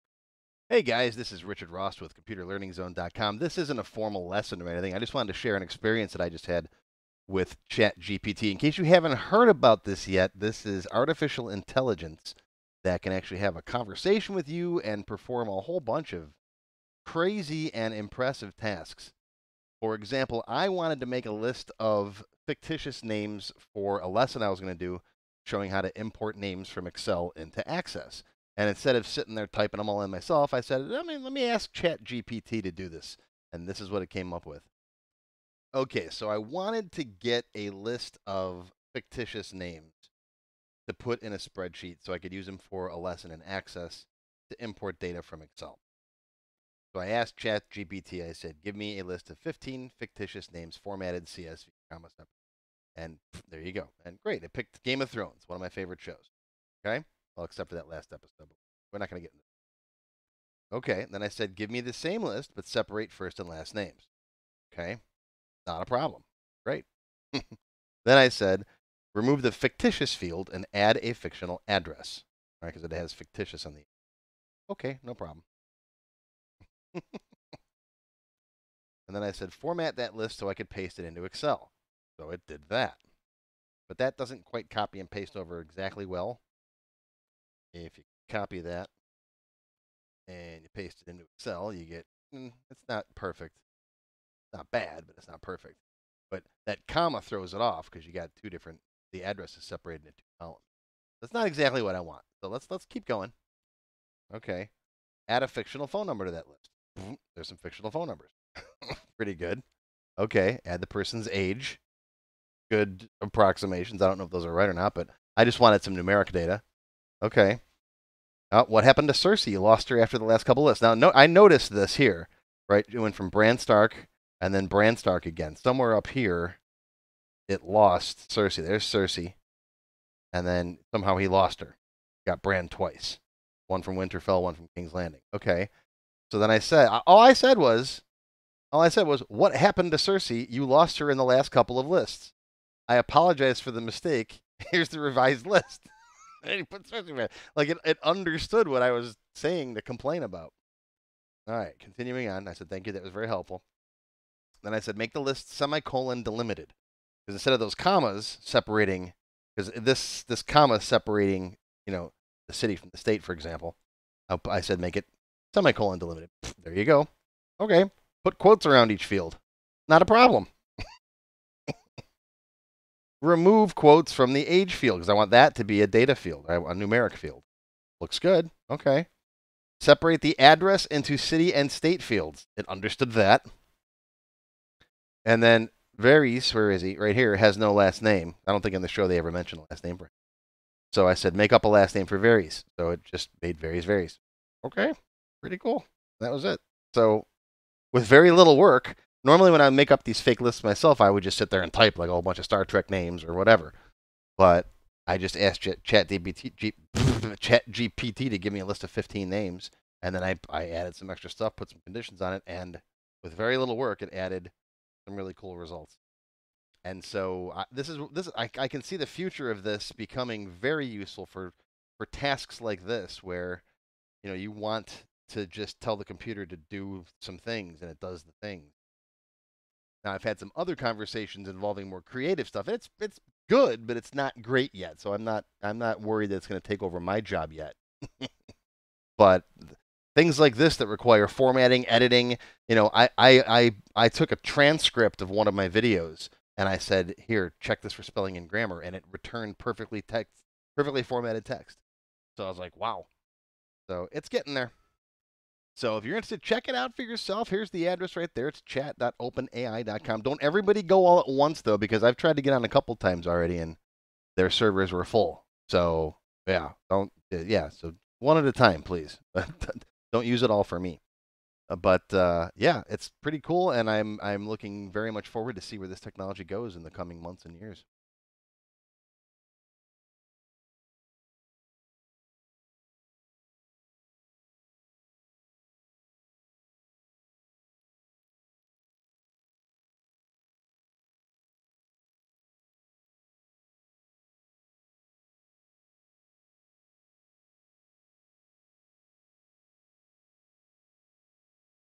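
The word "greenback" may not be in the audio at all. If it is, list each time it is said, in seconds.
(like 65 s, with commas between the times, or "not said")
not said.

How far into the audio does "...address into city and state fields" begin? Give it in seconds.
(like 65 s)
180 s.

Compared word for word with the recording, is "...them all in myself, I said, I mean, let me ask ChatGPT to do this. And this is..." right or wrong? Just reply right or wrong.
right.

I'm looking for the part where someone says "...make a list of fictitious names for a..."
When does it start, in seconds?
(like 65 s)
21 s.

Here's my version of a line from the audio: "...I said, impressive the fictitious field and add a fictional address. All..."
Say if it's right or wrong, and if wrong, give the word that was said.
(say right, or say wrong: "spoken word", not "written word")
wrong: "remove", not "impressive".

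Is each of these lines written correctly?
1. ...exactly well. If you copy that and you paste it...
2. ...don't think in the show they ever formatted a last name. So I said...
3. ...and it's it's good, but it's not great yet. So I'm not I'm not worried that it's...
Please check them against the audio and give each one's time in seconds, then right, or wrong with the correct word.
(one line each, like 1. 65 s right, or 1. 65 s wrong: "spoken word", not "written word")
1. 85 s right
2. 188 s wrong: "mentioned", not "formatted"
3. 232 s right.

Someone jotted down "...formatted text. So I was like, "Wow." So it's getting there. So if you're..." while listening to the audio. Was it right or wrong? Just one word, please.
right.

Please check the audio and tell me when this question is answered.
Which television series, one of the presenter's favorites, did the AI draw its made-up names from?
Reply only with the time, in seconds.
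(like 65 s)
54 s.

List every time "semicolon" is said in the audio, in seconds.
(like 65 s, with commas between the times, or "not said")
155 s, 165 s.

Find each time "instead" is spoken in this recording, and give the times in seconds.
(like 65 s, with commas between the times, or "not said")
28 s, 157 s.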